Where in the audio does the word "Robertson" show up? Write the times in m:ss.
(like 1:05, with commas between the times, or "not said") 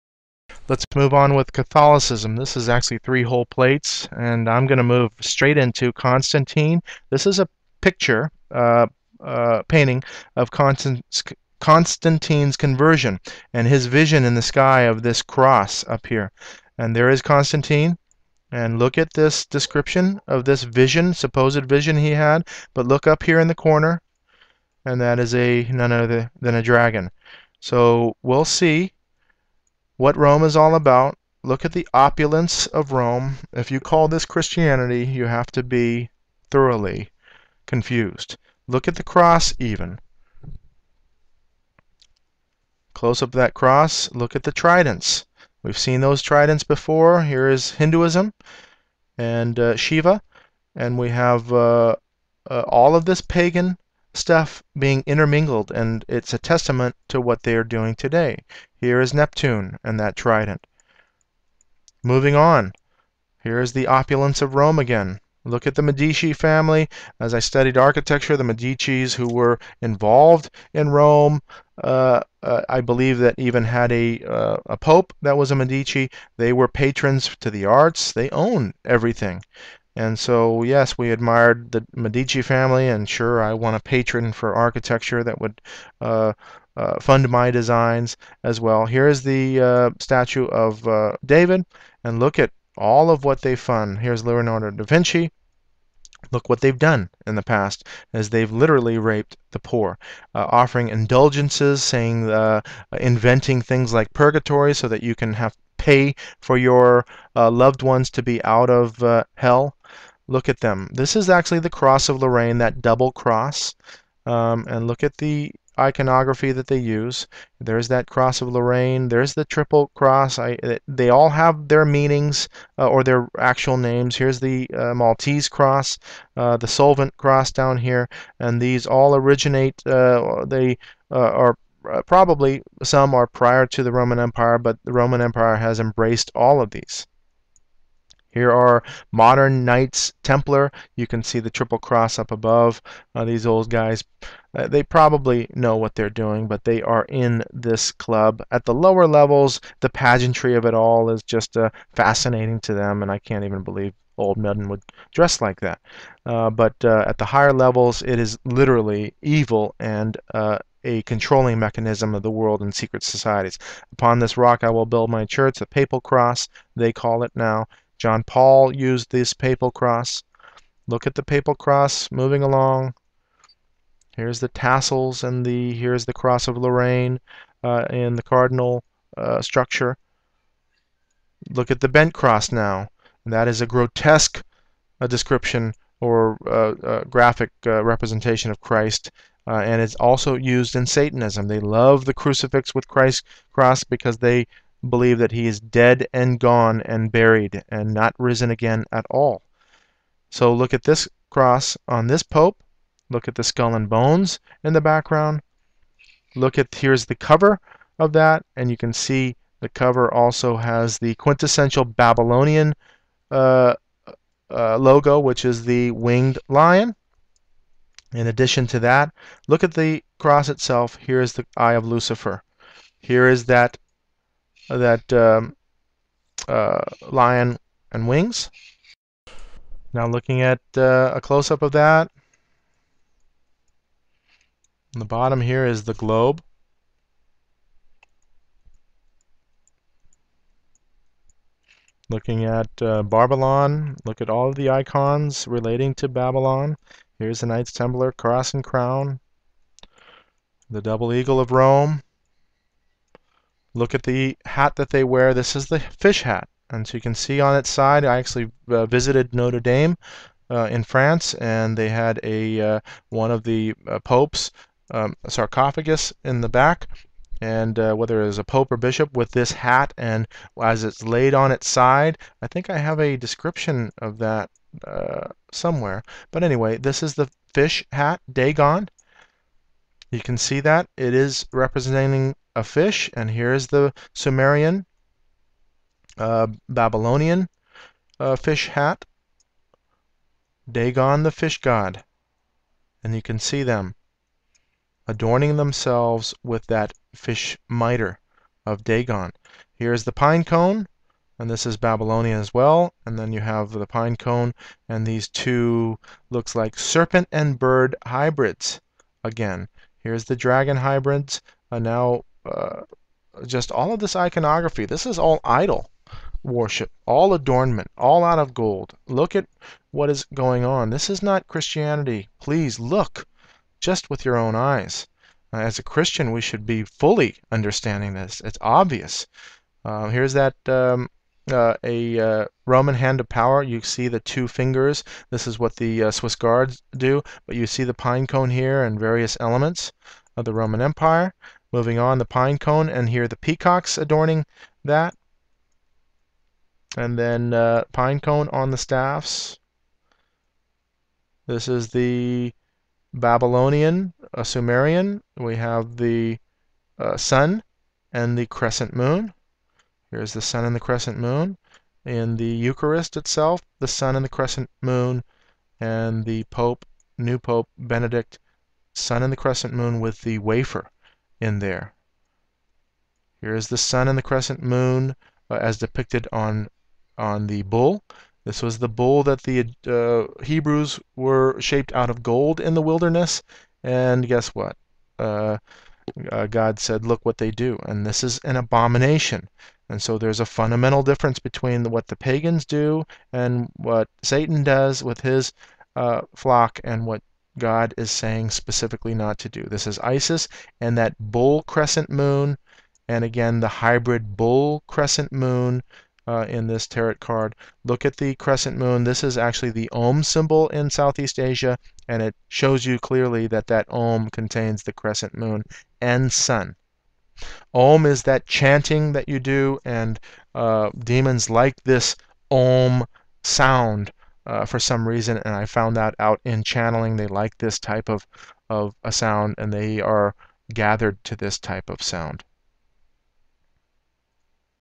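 not said.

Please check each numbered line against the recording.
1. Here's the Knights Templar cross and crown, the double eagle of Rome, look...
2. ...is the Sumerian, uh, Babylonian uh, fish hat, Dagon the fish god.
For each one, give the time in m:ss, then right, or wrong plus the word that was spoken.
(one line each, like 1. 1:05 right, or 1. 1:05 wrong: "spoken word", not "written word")
1. 4:07 right
2. 4:43 right.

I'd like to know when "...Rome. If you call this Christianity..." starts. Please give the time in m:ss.
0:32.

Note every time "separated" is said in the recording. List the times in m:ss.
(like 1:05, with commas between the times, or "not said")
not said.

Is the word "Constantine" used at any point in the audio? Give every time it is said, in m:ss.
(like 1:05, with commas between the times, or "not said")
0:05, 0:10, 0:17.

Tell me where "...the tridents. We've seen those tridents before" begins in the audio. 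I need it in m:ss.
0:44.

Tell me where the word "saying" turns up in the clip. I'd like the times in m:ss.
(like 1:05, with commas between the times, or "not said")
1:41, 6:38.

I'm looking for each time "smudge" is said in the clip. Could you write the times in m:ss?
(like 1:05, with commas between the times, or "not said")
not said.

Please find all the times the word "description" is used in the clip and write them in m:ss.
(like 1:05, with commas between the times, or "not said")
0:19, 3:05, 4:33.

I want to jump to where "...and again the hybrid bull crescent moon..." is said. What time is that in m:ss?
6:43.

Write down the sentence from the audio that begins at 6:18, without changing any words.
This was the bull that the uh, Hebrews were shaped out of gold in the wilderness, and guess what?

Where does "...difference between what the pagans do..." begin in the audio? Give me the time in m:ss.
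6:31.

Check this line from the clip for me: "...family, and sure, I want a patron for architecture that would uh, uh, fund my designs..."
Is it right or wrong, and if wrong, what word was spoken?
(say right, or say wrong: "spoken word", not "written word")
right.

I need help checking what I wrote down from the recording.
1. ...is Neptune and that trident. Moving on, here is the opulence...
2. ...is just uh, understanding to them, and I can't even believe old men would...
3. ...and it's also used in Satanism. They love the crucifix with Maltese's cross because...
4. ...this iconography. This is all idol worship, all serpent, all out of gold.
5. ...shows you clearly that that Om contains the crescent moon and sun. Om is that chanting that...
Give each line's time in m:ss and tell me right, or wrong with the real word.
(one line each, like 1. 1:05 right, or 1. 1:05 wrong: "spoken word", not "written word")
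1. 0:58 right
2. 2:31 wrong: "fascinating", not "understanding"
3. 3:09 wrong: "Christ", not "Maltese"
4. 5:13 wrong: "adornment", not "serpent"
5. 6:52 right.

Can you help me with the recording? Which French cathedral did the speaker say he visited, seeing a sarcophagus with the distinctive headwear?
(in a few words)
Notre Dame.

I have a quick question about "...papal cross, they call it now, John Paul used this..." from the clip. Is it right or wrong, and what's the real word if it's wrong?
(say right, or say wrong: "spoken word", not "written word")
right.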